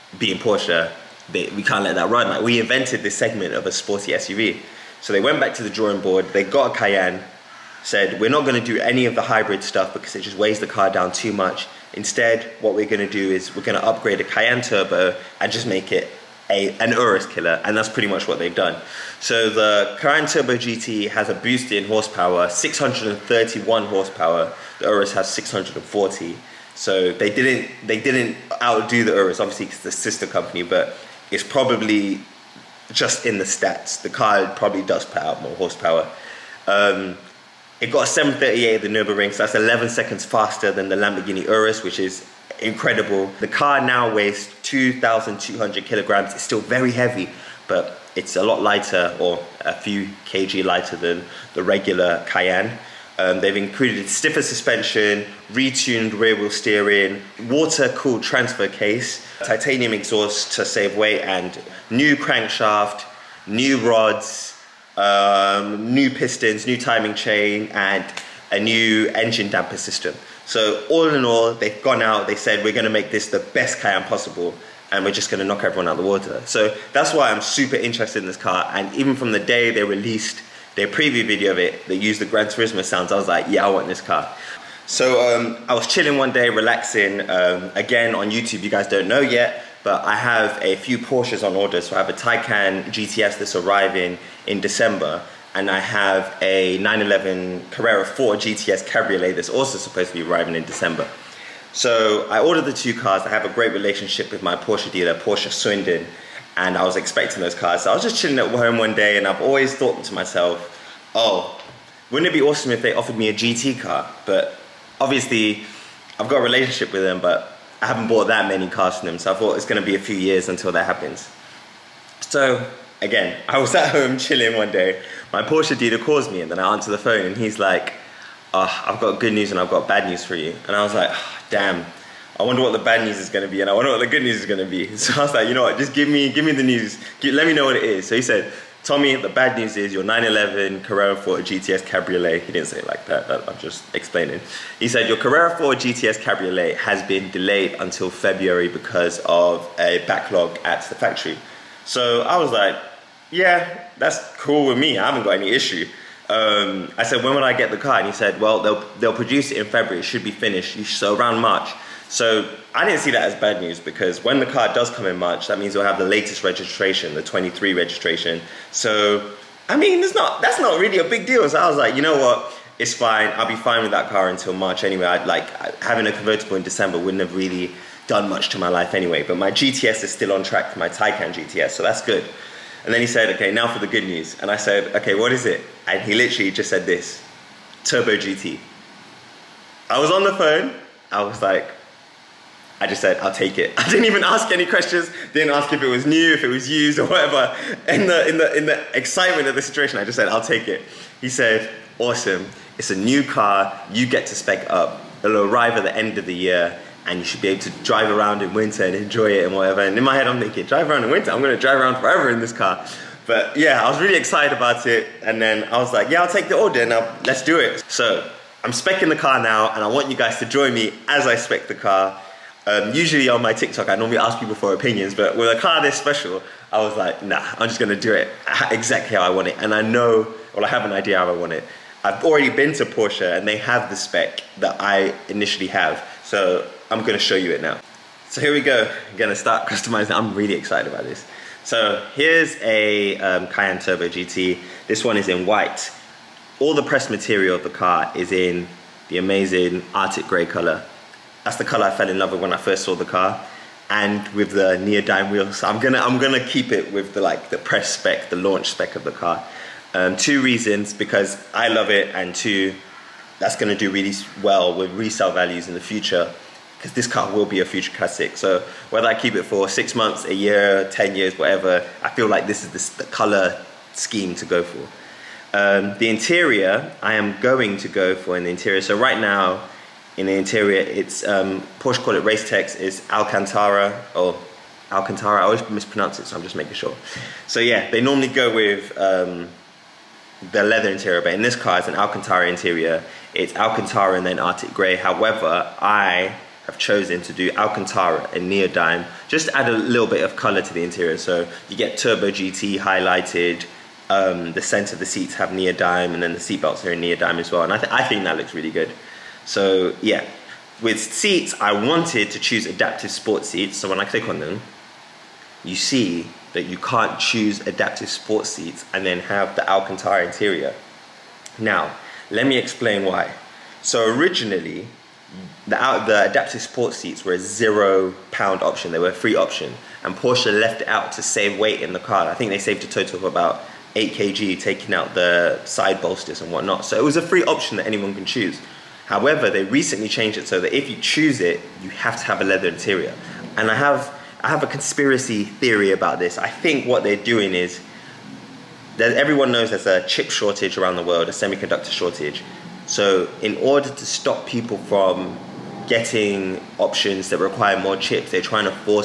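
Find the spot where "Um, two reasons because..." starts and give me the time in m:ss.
4:19.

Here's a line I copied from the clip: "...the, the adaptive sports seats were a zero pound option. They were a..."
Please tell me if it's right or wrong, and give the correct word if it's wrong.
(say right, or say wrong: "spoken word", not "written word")
right.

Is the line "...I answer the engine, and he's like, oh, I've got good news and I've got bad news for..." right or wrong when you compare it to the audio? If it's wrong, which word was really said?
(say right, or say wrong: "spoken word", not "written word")
wrong: "phone", not "engine".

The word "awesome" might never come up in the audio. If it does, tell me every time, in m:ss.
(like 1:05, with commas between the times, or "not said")
1:52, 3:22.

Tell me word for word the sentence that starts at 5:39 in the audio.
However, they recently changed it so that if you choose it, you have to have a leather interior.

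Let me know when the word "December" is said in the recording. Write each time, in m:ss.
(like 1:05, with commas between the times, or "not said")
1:34, 1:40, 2:56.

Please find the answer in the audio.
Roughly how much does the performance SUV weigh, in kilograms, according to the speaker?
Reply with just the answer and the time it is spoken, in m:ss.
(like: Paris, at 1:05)
2,200 kg, at 0:44.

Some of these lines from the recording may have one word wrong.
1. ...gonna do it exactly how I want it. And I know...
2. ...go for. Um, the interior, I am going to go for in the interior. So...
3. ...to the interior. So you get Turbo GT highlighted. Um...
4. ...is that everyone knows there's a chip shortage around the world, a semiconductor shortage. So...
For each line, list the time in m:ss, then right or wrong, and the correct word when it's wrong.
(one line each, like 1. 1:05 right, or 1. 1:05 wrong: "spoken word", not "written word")
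1. 3:47 right
2. 4:34 right
3. 5:00 right
4. 5:47 right.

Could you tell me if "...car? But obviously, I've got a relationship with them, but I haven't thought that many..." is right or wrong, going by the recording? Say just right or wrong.
wrong.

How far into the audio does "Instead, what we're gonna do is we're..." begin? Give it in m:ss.
0:11.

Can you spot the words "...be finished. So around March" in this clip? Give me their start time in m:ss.
2:40.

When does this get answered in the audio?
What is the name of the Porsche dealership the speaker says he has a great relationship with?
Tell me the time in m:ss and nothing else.
1:45.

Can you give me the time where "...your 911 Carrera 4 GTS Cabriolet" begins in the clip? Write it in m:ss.
2:19.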